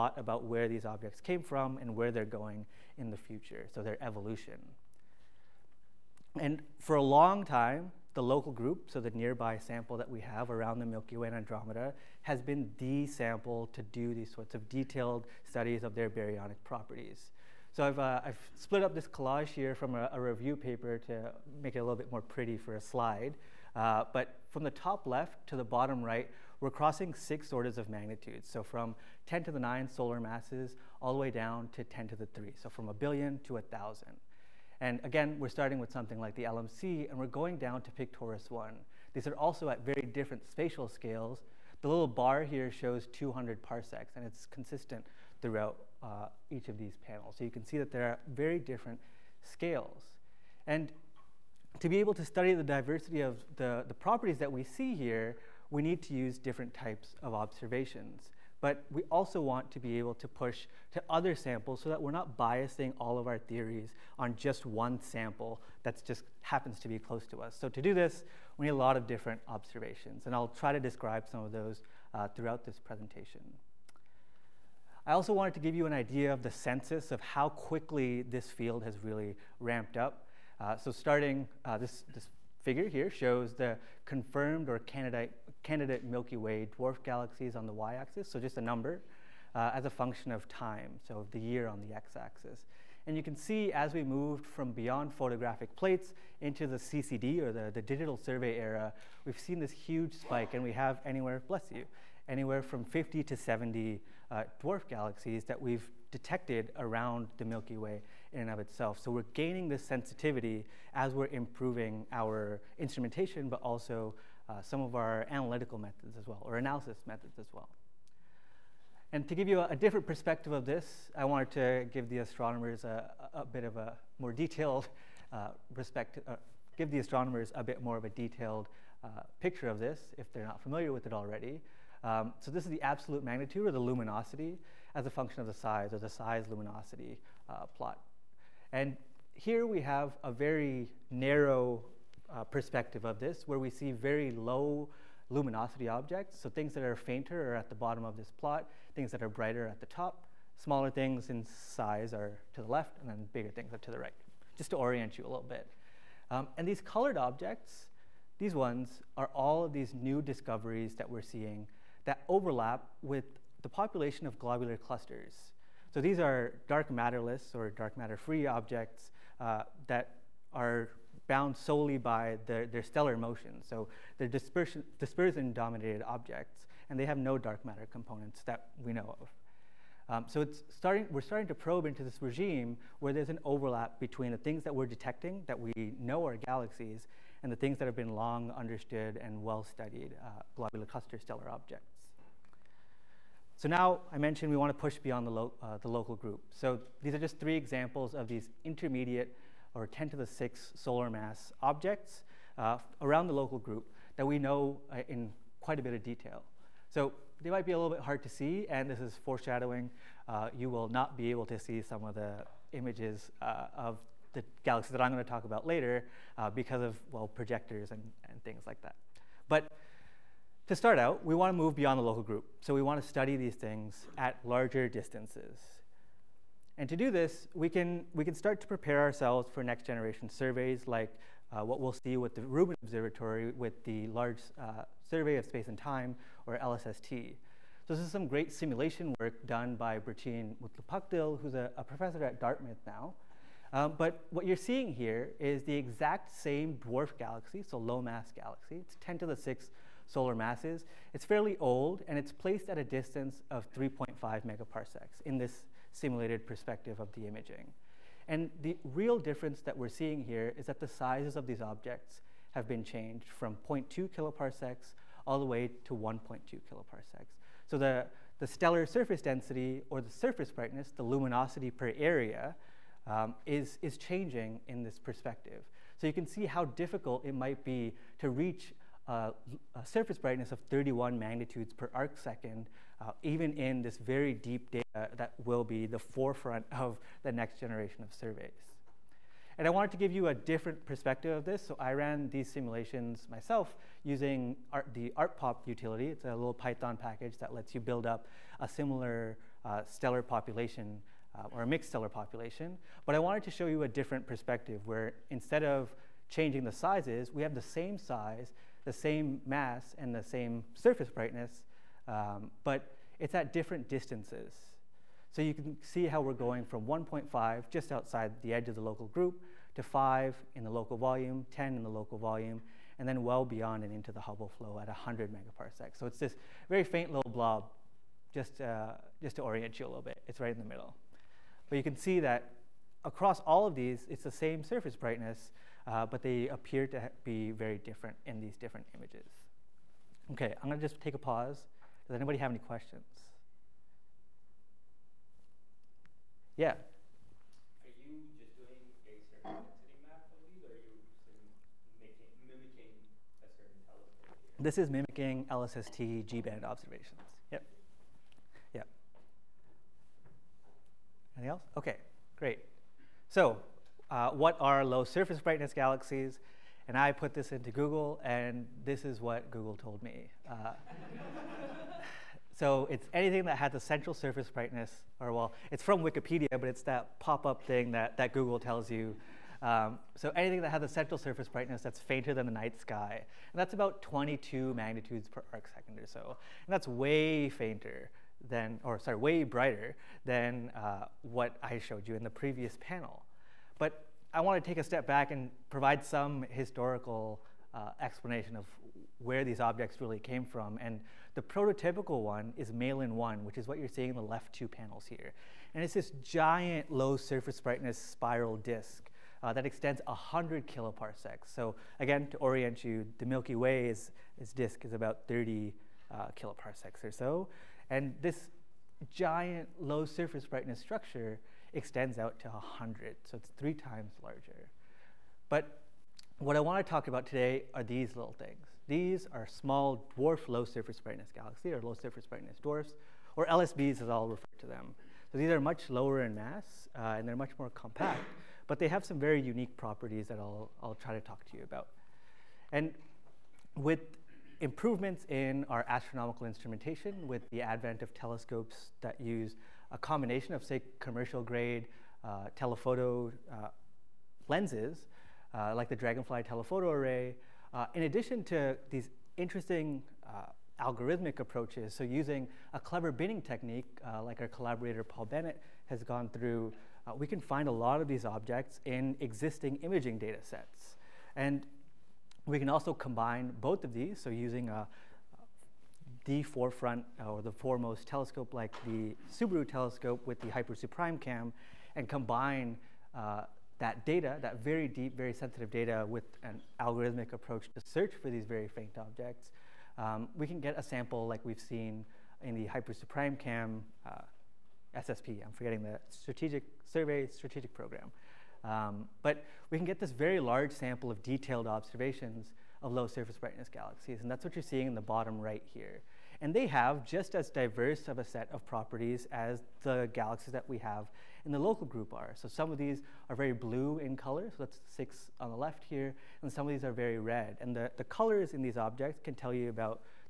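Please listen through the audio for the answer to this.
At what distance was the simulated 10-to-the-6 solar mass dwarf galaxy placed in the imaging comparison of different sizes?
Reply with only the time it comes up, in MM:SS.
04:13.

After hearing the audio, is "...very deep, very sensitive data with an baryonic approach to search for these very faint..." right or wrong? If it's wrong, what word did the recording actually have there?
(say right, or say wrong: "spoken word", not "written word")
wrong: "algorithmic", not "baryonic".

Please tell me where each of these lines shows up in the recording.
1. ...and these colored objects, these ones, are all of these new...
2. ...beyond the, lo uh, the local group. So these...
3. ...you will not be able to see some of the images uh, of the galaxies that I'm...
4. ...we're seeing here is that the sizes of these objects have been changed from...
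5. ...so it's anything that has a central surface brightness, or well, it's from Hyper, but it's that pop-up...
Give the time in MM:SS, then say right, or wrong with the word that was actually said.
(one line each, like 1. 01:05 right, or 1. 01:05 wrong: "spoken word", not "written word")
1. 02:36 right
2. 03:14 right
3. 03:30 right
4. 04:19 right
5. 06:12 wrong: "Wikipedia", not "Hyper".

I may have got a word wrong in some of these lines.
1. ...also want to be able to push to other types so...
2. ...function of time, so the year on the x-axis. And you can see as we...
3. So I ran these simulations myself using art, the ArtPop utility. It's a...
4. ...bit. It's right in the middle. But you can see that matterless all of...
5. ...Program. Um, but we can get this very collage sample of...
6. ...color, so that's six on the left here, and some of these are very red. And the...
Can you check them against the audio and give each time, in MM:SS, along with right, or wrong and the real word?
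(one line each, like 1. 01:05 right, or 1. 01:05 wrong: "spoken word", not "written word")
1. 00:59 wrong: "samples", not "types"
2. 01:29 right
3. 04:51 right
4. 05:30 wrong: "across", not "matterless"
5. 08:17 wrong: "large", not "collage"
6. 08:34 right.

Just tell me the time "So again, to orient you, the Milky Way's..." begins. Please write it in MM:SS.
06:51.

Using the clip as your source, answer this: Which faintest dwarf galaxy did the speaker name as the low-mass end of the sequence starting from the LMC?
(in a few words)
Pictoris 1.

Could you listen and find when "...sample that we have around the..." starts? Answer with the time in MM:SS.
00:09.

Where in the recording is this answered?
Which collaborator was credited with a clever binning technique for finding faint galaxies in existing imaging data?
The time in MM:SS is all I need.
07:45.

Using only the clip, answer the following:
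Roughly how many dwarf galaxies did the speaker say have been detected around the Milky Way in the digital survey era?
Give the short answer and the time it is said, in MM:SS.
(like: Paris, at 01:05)
50 to 70, at 01:42.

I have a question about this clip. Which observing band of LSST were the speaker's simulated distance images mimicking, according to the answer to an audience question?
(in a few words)
G-band.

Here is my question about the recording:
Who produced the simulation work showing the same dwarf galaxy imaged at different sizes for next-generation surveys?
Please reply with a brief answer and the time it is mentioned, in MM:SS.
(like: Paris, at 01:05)
Burçin Mutlu-Pakdil, at 03:59.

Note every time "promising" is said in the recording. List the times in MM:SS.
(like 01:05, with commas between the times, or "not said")
not said.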